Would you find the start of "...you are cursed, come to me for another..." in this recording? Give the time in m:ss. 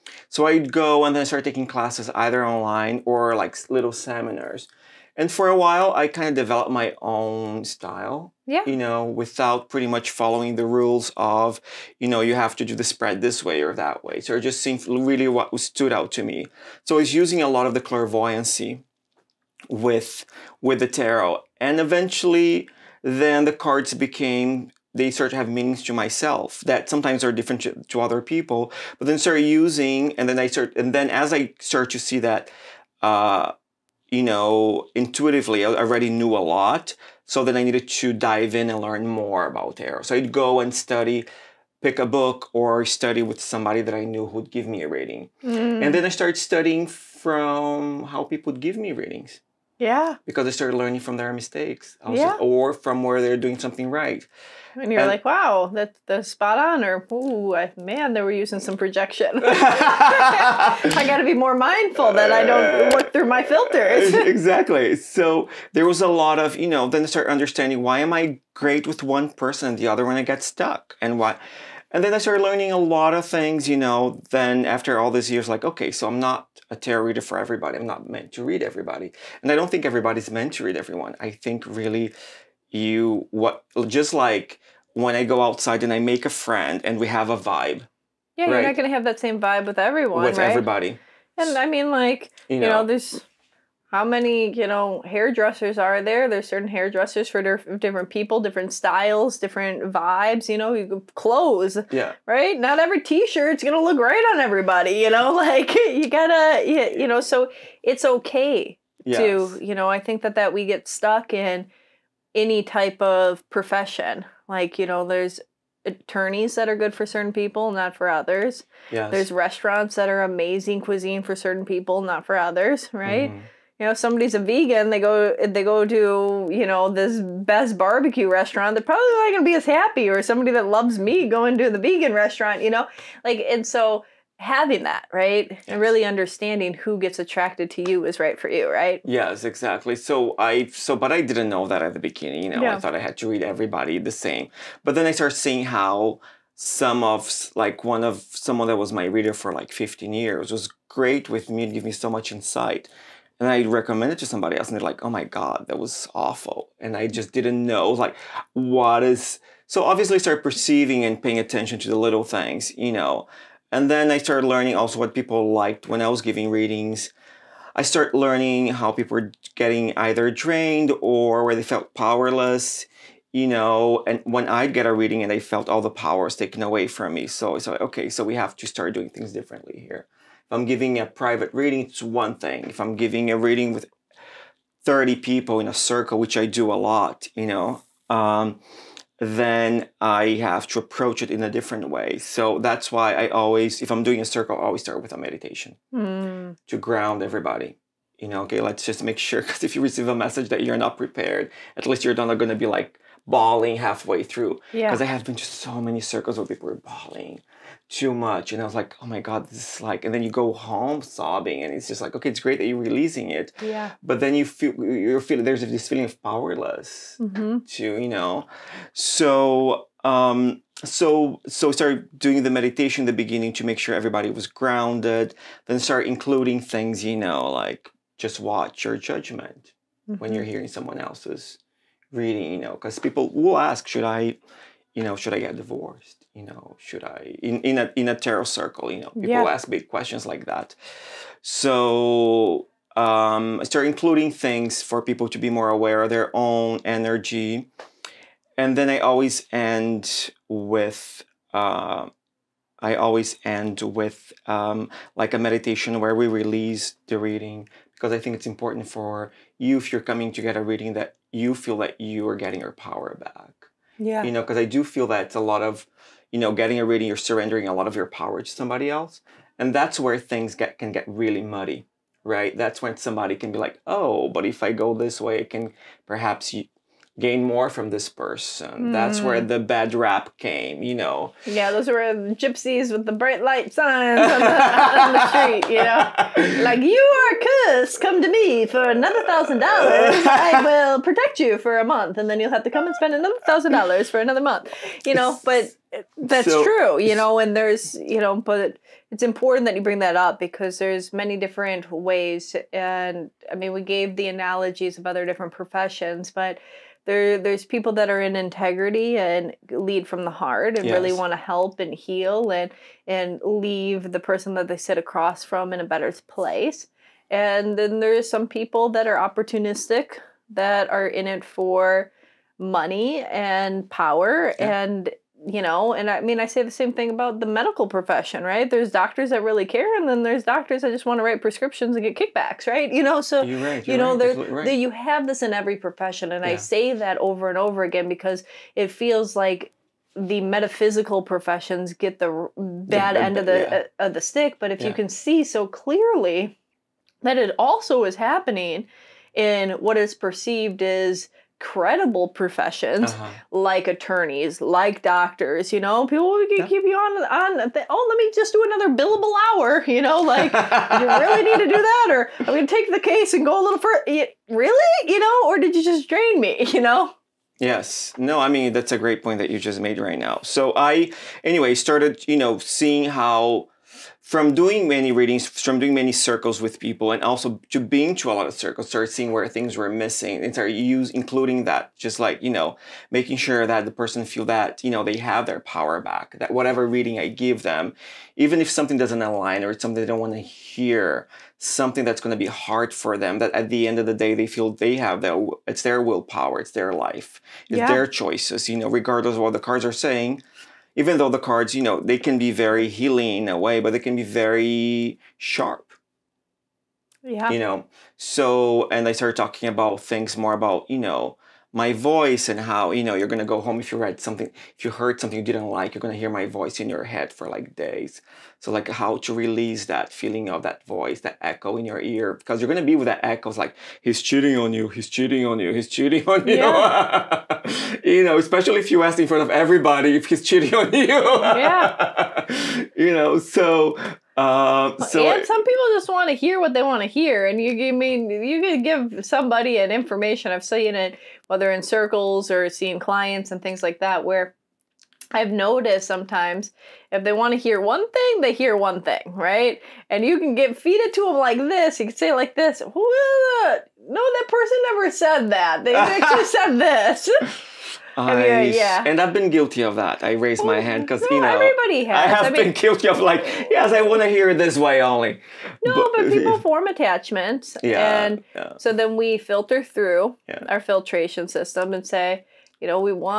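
4:46.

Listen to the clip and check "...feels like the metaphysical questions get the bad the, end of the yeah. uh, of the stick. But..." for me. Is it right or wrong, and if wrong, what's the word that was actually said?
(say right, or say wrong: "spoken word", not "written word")
wrong: "professions", not "questions".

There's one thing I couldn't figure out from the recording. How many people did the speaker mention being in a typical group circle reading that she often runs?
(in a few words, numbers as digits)
30.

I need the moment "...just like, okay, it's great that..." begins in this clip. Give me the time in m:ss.
3:31.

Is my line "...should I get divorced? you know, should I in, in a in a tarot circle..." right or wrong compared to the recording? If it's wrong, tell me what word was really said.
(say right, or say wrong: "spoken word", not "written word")
right.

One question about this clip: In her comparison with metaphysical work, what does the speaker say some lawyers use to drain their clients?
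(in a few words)
billable hour.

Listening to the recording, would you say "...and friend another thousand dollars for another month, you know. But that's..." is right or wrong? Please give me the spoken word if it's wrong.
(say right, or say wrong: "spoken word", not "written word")
wrong: "spend", not "friend".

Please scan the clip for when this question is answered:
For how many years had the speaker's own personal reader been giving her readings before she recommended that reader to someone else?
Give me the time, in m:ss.
2:29.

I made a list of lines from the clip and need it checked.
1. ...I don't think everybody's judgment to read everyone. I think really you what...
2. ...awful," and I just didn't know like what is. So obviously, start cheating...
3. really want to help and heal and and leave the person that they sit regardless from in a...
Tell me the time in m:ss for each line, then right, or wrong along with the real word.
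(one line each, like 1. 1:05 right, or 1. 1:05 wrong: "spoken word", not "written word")
1. 1:19 wrong: "meant", not "judgment"
2. 2:36 wrong: "perceiving", not "cheating"
3. 5:10 wrong: "across", not "regardless".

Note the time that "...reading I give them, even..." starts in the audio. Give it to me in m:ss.
6:26.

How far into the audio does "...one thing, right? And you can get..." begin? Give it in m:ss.
7:28.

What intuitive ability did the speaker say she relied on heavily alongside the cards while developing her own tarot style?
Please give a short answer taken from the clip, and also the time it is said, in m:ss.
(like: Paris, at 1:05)
clairvoyancy, at 0:17.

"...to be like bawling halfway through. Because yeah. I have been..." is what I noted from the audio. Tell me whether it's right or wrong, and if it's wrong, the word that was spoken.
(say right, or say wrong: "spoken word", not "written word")
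right.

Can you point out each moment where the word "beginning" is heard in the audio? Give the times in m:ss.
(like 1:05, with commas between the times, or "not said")
2:21, 3:43.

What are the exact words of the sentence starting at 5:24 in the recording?
and you know, and I mean, I say the same thing about the medical profession, right?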